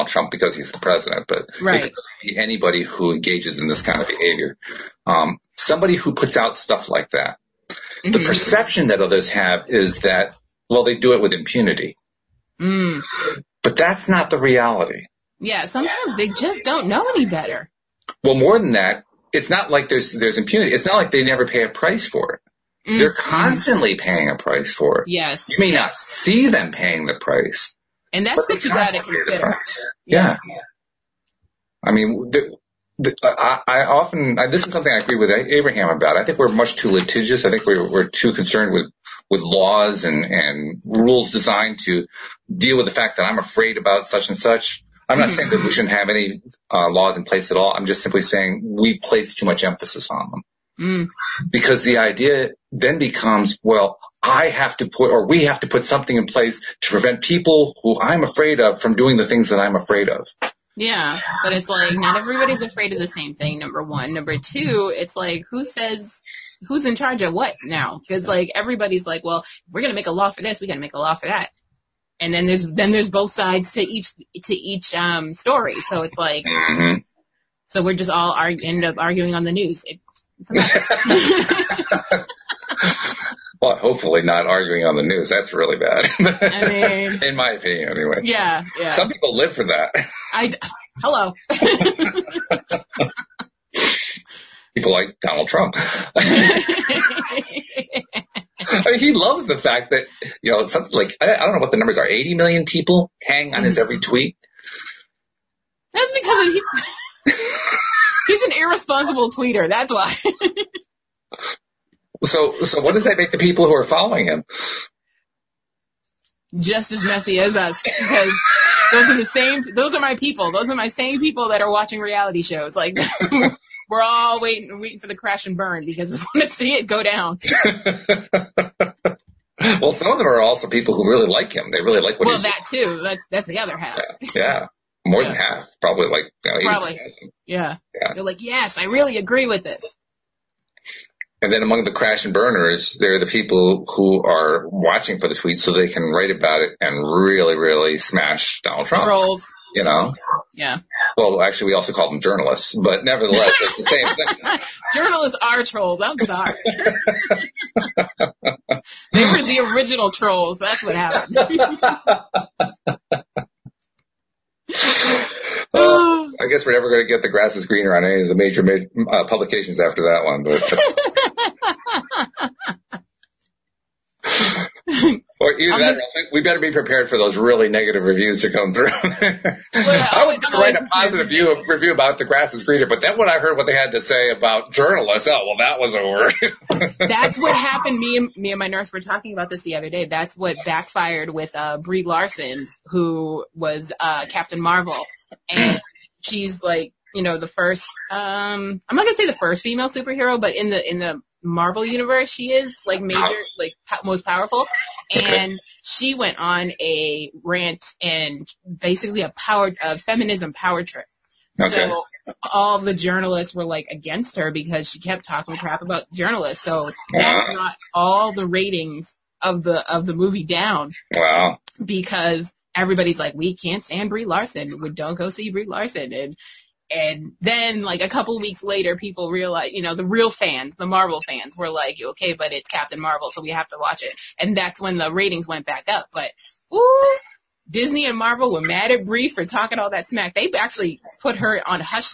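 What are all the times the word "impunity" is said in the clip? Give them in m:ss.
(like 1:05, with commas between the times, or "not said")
0:11, 0:20.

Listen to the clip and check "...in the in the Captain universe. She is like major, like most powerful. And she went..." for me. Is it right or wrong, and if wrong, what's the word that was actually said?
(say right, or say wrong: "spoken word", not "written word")
wrong: "Marvel", not "Captain".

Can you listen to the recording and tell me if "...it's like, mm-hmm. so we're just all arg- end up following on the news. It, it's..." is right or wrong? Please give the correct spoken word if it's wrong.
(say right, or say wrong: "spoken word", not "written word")
wrong: "arguing", not "following".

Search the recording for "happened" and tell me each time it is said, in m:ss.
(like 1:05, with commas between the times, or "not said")
2:40, 3:07.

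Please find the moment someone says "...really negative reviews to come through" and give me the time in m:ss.
2:57.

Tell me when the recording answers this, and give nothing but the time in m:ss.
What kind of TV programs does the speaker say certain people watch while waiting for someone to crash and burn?
2:02.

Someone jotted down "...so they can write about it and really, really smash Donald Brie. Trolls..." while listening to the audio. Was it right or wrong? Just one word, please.
wrong.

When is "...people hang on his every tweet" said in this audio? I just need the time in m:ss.
1:42.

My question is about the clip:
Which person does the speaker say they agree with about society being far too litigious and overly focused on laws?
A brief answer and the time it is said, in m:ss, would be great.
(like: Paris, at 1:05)
Abraham, at 0:35.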